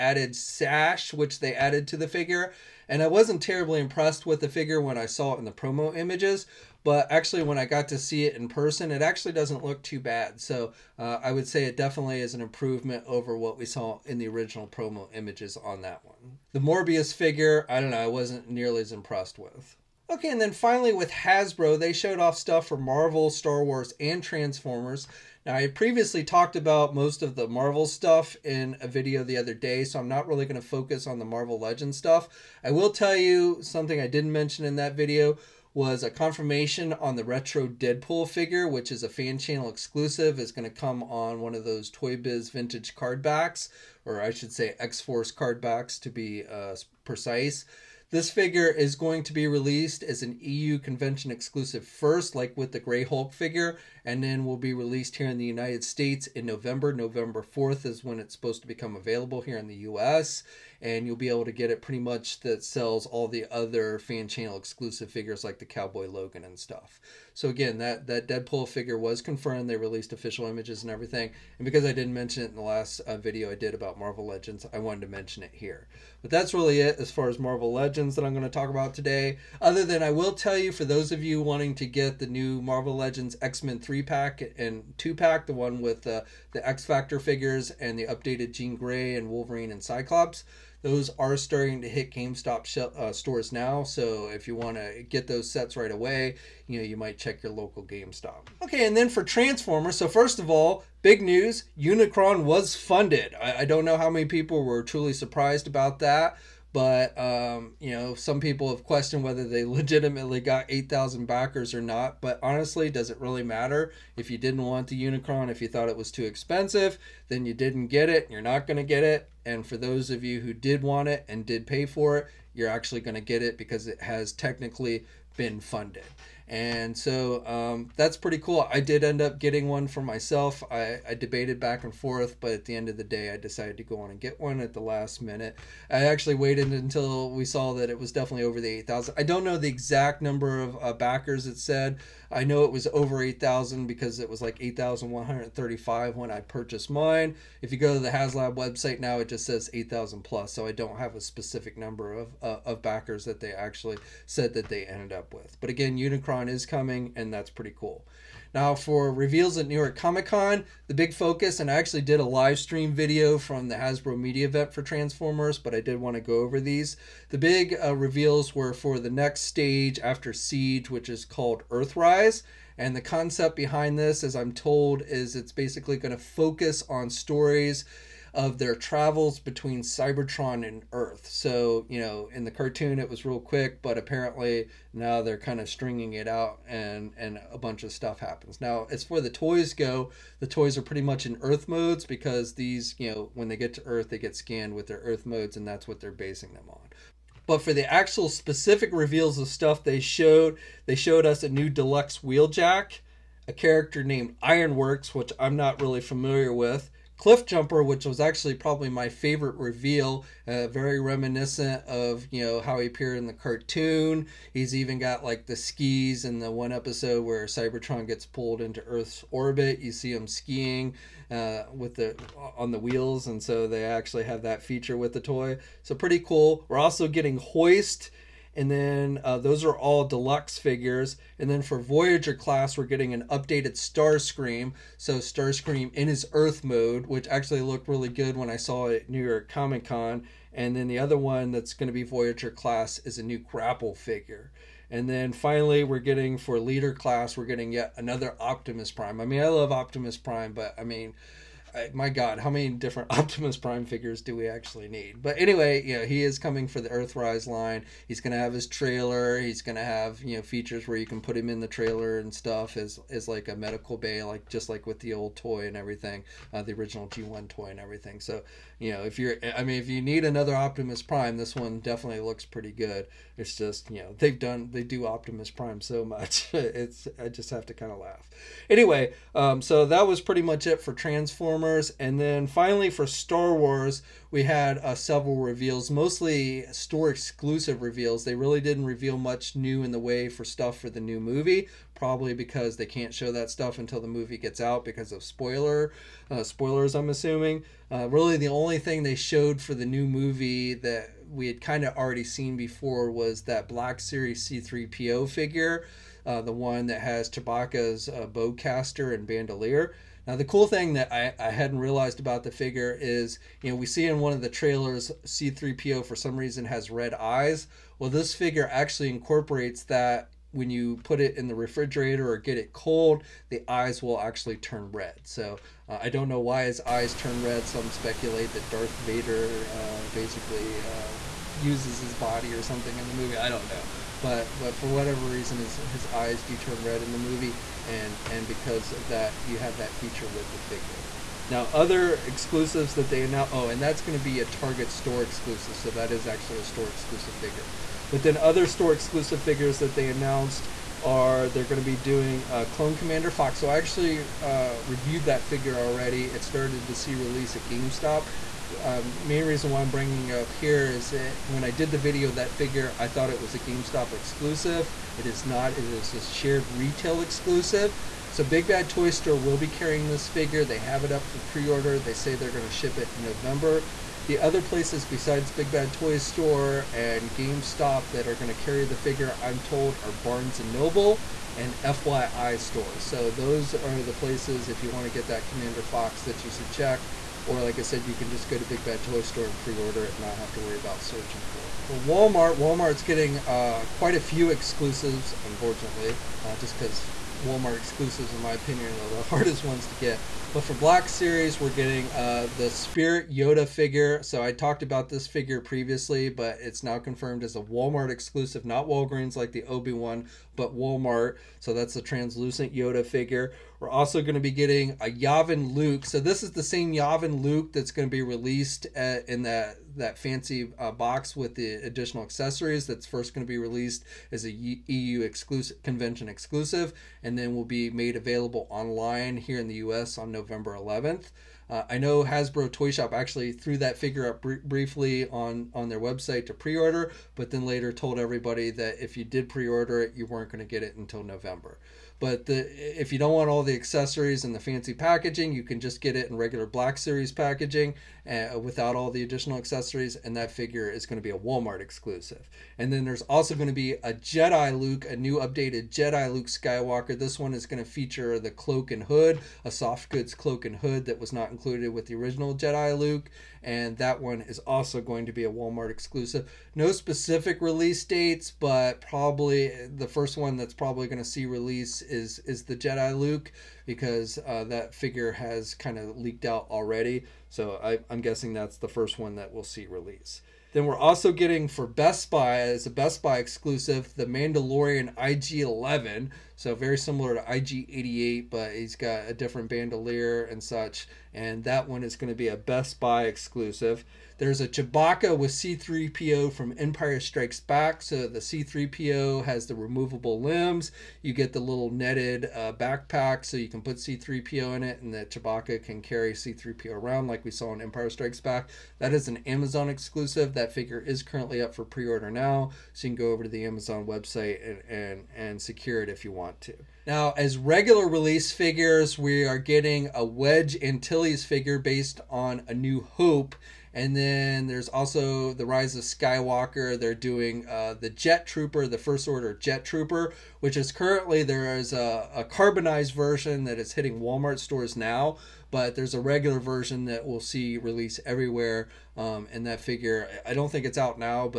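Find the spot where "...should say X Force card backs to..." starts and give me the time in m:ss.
0:44.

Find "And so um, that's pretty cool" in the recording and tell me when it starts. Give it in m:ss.
2:06.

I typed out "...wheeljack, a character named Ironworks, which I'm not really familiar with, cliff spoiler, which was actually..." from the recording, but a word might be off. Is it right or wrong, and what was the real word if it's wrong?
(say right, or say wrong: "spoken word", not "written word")
wrong: "jumper", not "spoiler".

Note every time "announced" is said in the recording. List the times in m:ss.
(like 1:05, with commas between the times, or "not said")
5:43, 5:50.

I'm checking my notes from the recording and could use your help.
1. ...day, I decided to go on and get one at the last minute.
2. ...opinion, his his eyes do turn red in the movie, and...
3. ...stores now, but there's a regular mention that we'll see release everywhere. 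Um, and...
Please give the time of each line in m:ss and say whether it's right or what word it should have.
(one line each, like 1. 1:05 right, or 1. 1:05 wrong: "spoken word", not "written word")
1. 2:13 right
2. 5:35 wrong: "reason", not "opinion"
3. 8:54 wrong: "version", not "mention".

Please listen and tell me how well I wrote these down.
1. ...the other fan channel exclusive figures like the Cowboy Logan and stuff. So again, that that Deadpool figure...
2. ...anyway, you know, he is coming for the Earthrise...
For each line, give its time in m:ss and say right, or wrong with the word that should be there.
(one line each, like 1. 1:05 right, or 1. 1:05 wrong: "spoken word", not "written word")
1. 1:03 right
2. 4:15 right.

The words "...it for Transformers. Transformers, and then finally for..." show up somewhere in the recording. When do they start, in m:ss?
4:40.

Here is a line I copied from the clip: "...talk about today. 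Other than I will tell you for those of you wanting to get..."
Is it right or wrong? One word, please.
right.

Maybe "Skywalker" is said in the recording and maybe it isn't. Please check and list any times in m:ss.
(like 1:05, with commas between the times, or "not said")
7:36, 8:46.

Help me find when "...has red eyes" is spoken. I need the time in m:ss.
5:16.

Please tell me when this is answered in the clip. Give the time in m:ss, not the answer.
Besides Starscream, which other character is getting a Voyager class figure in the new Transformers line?
4:03.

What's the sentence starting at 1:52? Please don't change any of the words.
But honestly, does it really matter?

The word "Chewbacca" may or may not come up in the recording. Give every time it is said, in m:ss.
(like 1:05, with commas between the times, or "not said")
5:07, 8:14, 8:25.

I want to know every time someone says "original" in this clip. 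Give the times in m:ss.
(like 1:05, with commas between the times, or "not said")
0:14, 4:26, 7:42.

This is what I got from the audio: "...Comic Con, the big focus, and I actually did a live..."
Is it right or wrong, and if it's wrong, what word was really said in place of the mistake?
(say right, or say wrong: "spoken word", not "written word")
right.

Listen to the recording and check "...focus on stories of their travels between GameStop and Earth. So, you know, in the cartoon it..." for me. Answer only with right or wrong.
wrong.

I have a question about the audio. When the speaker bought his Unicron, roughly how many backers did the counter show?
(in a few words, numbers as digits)
8,135.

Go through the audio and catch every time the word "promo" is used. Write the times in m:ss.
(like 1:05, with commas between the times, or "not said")
0:05, 0:14.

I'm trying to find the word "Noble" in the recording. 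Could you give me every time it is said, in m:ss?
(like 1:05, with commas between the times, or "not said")
6:20.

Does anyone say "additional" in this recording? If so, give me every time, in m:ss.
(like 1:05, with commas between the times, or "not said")
7:01, 7:29.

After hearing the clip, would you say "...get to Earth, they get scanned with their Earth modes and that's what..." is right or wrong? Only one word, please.
right.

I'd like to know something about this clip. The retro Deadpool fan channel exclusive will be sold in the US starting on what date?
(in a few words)
November 4th.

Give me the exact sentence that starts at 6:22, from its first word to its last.
So those are the places if you want to get that Commander Fox that you should check.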